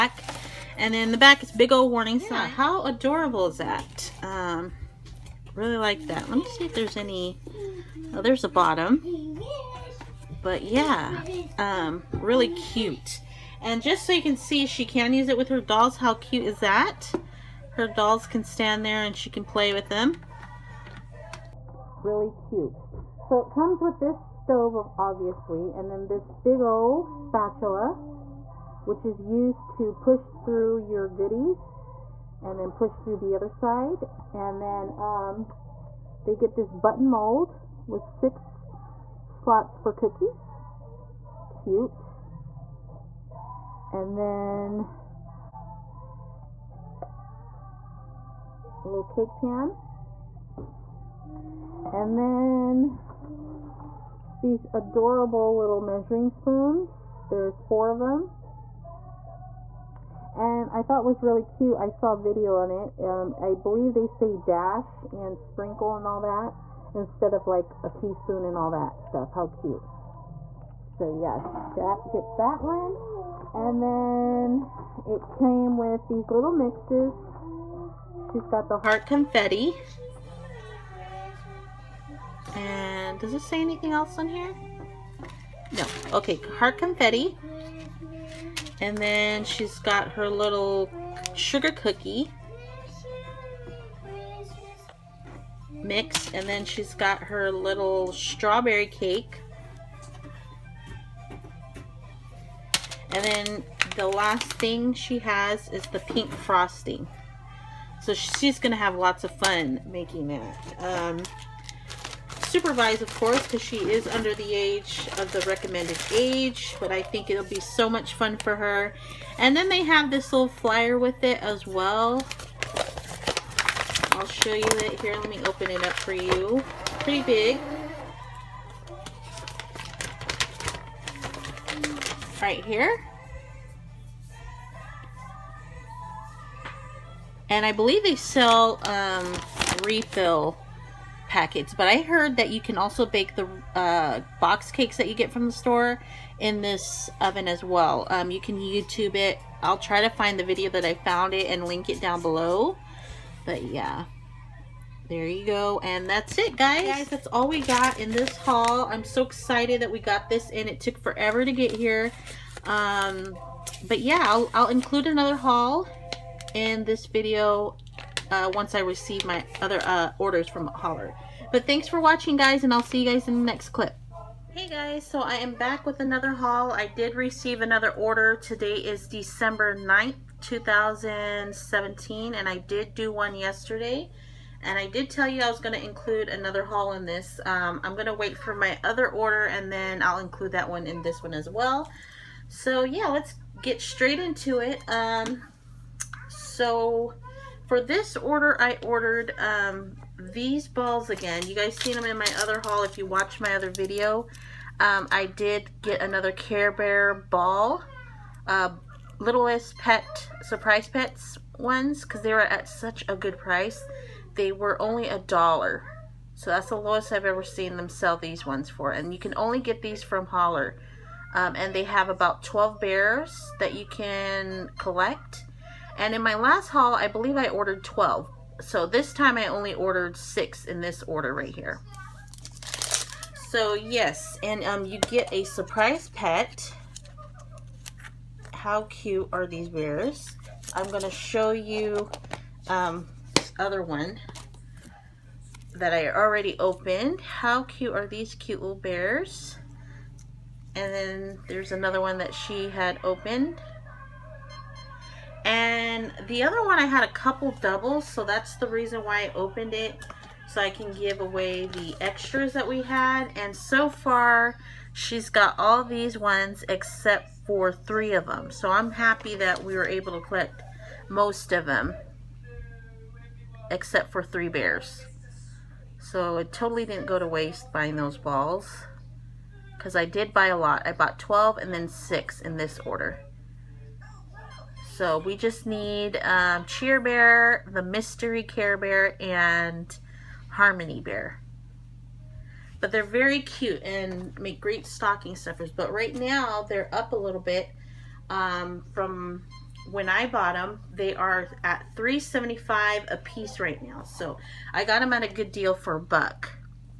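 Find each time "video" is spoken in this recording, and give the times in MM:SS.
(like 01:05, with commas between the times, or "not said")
01:02, 02:30, 02:47, 03:23.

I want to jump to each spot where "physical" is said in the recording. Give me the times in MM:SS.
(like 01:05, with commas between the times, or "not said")
not said.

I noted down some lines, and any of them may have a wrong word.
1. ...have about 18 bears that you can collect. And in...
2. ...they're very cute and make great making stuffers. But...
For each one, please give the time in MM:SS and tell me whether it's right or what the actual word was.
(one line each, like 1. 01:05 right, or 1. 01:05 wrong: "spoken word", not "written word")
1. 03:41 wrong: "12", not "18"
2. 04:52 wrong: "stocking", not "making".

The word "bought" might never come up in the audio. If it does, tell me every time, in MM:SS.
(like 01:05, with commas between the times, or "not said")
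04:40, 05:00.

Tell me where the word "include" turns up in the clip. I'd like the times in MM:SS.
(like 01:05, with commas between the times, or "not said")
02:44, 03:05, 03:10.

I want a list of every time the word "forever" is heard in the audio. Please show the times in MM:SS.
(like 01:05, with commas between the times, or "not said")
02:41.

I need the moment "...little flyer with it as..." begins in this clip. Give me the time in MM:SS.
02:00.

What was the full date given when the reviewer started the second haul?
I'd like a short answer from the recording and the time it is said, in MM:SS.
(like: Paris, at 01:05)
December 9th, 2017, at 02:59.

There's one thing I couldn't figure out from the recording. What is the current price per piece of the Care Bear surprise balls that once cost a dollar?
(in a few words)
3.75.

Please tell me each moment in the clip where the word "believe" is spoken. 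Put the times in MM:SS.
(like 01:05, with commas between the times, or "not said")
01:03, 02:17, 03:47.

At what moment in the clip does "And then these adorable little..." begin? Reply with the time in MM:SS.
00:51.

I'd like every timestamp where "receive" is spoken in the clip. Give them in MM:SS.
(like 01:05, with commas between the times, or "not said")
02:48, 02:57.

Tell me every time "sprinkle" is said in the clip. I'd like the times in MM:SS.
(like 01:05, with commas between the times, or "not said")
01:05.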